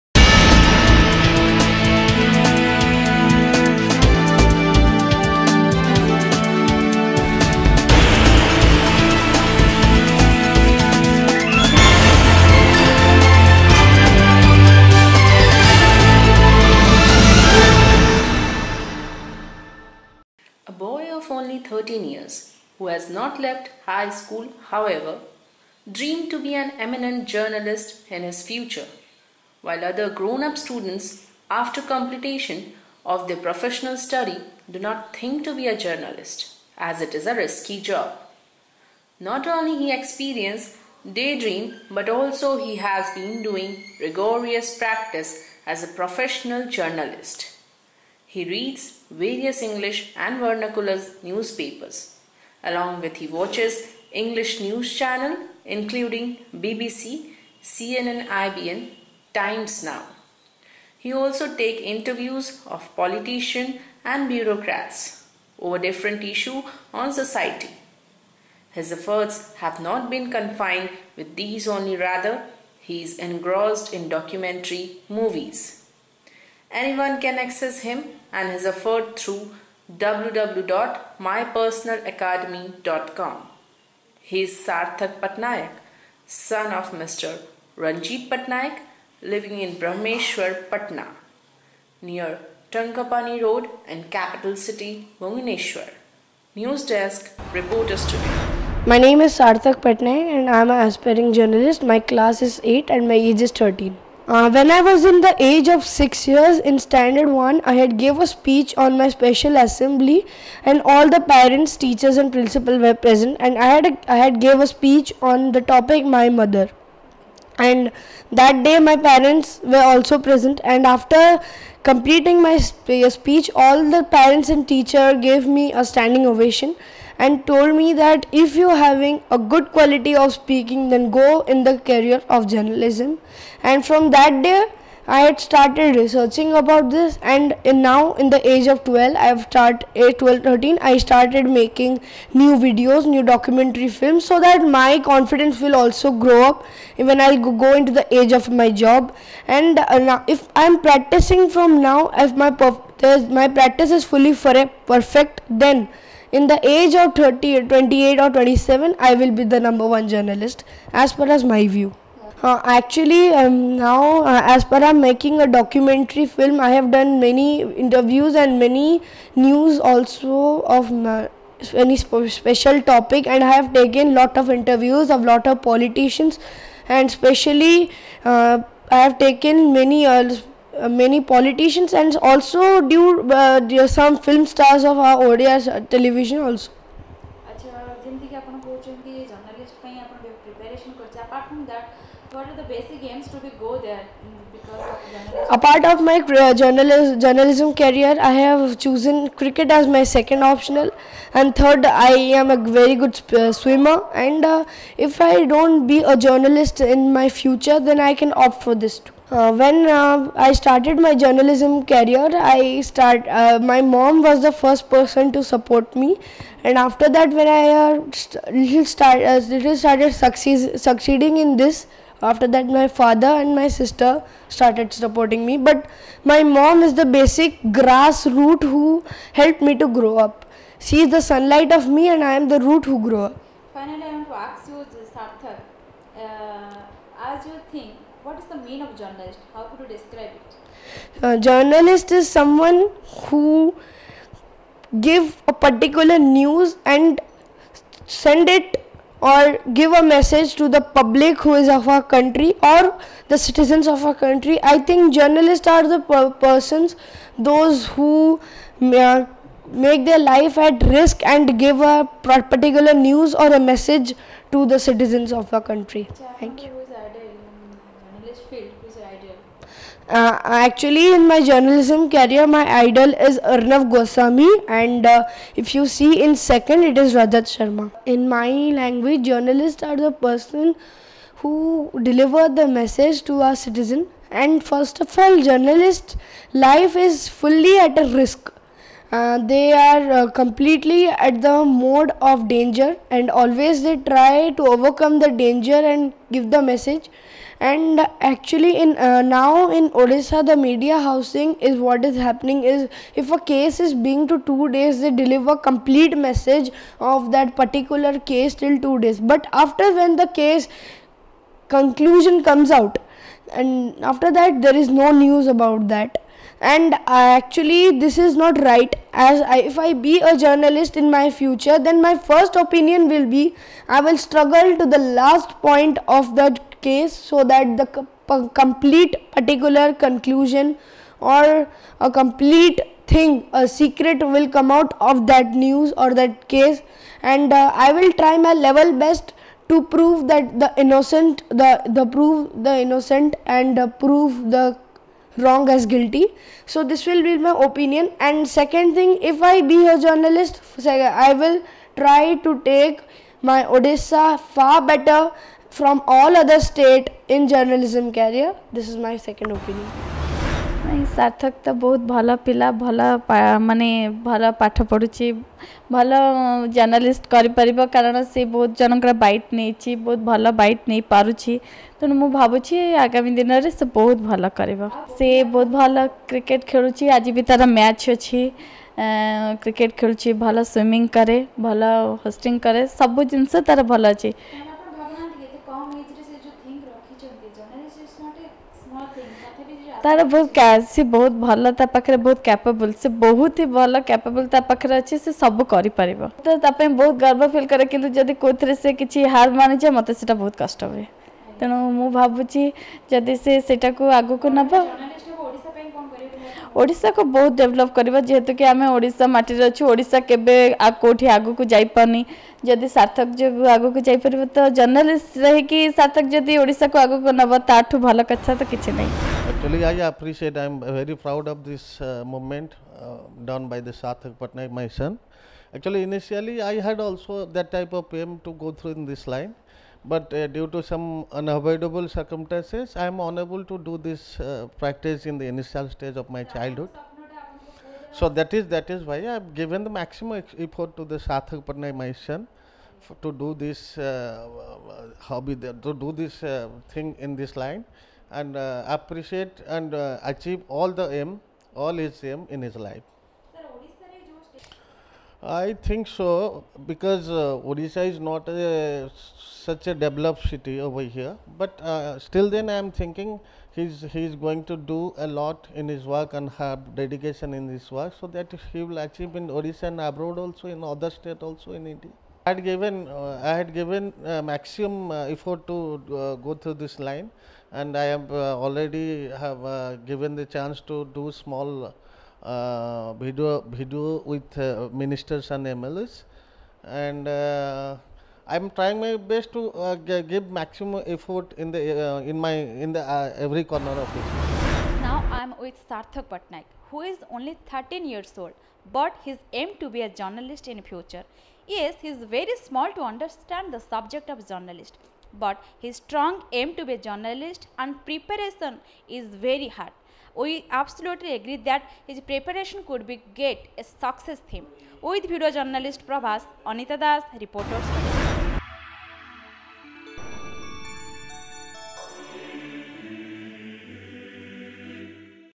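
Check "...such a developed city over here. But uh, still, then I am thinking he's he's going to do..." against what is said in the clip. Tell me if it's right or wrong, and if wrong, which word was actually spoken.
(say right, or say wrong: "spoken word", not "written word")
right.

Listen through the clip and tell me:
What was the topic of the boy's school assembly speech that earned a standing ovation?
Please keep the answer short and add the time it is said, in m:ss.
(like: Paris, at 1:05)
My mother, at 1:56.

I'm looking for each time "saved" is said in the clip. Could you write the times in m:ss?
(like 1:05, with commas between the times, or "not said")
not said.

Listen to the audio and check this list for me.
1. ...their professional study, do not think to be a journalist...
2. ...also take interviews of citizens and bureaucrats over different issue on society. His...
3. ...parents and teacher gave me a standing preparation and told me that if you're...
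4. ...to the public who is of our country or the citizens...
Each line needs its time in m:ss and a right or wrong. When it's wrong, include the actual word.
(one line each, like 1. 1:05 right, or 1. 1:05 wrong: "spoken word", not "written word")
1. 0:33 right
2. 1:01 wrong: "politicians", not "citizens"
3. 2:04 wrong: "ovation", not "preparation"
4. 4:10 right.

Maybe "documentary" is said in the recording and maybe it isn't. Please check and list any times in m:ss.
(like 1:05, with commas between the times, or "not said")
1:14, 2:23, 2:45.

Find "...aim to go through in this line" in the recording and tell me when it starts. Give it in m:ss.
7:08.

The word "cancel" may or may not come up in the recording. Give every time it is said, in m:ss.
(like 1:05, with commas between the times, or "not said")
not said.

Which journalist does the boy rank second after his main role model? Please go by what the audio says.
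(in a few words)
Rajat Sharma.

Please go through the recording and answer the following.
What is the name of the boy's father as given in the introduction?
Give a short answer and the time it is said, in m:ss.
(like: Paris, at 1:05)
Ranjit Patnaik, at 1:26.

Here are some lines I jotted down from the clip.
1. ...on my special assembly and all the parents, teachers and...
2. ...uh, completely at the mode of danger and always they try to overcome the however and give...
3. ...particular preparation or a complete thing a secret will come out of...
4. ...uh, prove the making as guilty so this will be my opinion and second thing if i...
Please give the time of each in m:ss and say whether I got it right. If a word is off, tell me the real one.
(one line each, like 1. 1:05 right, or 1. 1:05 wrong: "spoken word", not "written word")
1. 1:48 right
2. 4:50 wrong: "danger", not "however"
3. 5:29 wrong: "conclusion", not "preparation"
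4. 5:43 wrong: "wrong", not "making".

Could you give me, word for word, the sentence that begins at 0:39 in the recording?
Not only he experienced daydream, but also he has been doing rigorous practice as a professional journalist.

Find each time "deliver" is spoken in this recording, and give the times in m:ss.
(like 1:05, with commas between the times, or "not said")
4:42, 5:05.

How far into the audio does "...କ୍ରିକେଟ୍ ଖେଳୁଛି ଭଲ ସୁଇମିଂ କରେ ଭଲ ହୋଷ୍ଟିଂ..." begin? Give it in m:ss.
6:19.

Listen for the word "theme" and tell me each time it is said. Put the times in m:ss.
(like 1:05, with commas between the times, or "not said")
8:34.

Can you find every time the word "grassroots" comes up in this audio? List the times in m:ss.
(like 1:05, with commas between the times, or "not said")
3:47.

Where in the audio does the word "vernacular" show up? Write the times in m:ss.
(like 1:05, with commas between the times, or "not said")
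0:50.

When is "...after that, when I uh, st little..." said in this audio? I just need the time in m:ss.
3:36.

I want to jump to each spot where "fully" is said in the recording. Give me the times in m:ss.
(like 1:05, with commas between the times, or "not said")
2:34, 4:47.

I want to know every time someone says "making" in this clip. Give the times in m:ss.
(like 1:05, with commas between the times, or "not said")
2:21, 2:45.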